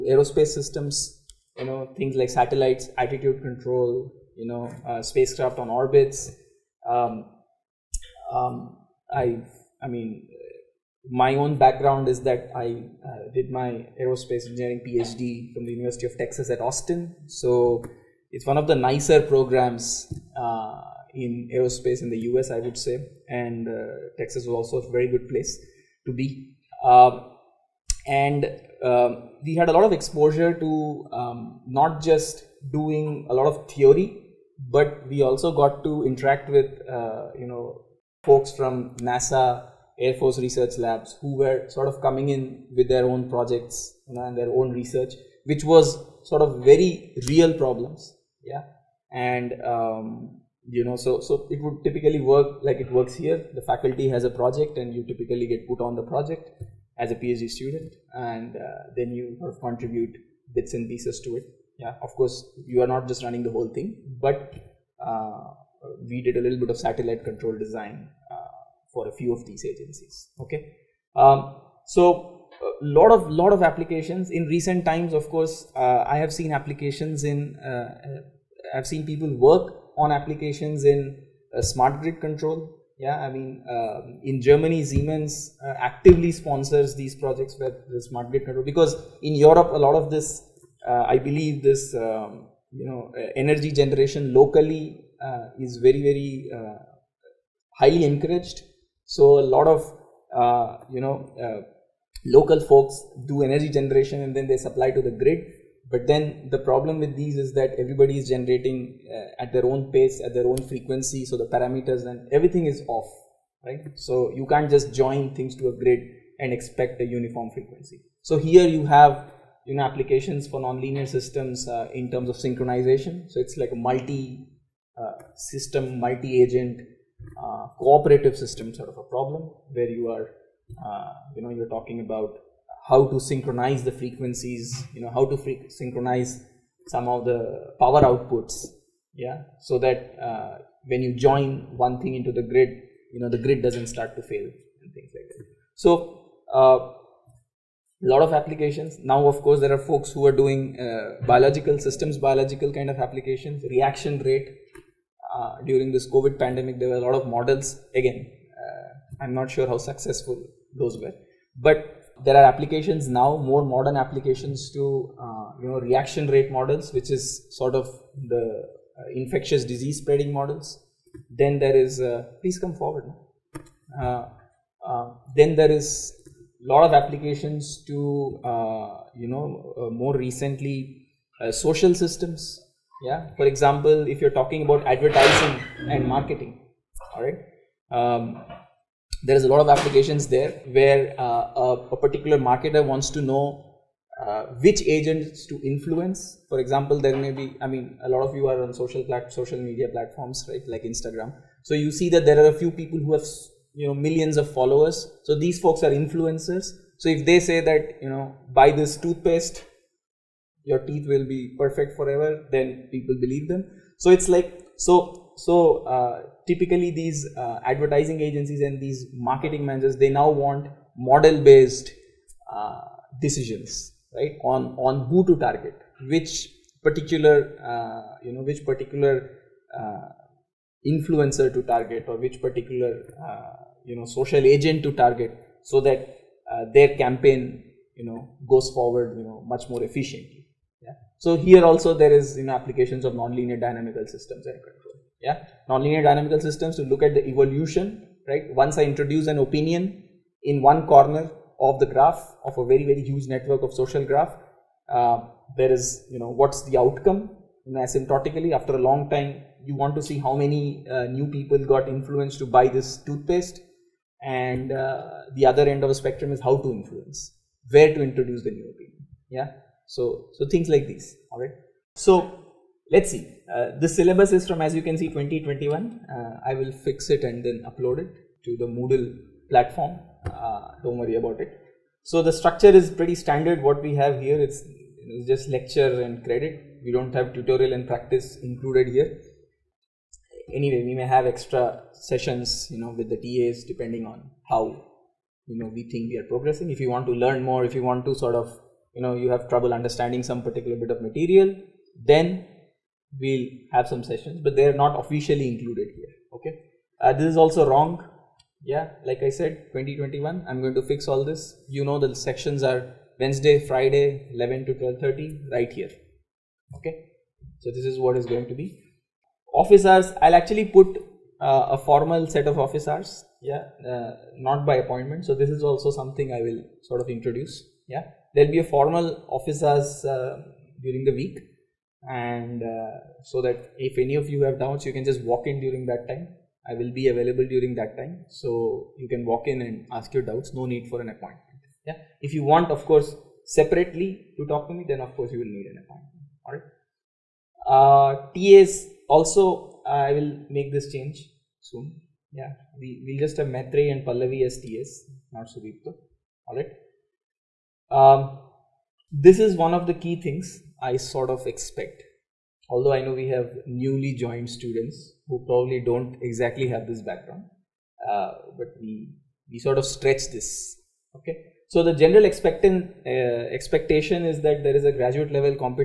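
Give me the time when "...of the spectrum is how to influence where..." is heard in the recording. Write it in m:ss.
4:25.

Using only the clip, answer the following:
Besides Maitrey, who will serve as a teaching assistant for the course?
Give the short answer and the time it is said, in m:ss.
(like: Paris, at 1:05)
Pallavi, at 5:54.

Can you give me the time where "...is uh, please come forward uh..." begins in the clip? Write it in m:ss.
2:51.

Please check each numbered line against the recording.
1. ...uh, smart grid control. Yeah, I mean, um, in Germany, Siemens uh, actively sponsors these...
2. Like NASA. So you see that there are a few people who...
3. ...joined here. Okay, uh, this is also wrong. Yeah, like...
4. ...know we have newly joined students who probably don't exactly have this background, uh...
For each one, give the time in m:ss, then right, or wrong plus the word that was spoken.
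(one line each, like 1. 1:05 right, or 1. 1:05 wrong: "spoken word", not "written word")
1. 1:21 right
2. 3:20 wrong: "Instagram", not "NASA"
3. 5:05 wrong: "included", not "joined"
4. 6:03 right.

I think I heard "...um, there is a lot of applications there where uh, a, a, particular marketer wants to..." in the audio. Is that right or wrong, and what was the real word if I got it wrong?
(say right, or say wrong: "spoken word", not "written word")
right.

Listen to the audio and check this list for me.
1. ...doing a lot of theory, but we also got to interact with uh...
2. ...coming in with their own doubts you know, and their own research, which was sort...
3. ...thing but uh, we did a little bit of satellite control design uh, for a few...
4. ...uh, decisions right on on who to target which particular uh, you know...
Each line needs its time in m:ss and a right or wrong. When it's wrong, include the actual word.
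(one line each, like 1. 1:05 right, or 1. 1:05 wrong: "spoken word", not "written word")
1. 0:32 right
2. 0:42 wrong: "projects", not "doubts"
3. 1:03 right
4. 3:42 right.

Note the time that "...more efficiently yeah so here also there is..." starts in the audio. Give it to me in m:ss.
3:59.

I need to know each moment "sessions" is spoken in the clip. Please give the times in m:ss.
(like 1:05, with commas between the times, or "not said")
4:51, 5:04.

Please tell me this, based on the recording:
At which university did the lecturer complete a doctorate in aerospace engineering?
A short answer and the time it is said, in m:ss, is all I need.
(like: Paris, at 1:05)
University of Texas at Austin, at 0:15.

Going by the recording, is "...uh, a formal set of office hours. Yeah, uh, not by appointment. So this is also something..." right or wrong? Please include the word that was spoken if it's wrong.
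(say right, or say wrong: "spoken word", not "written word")
right.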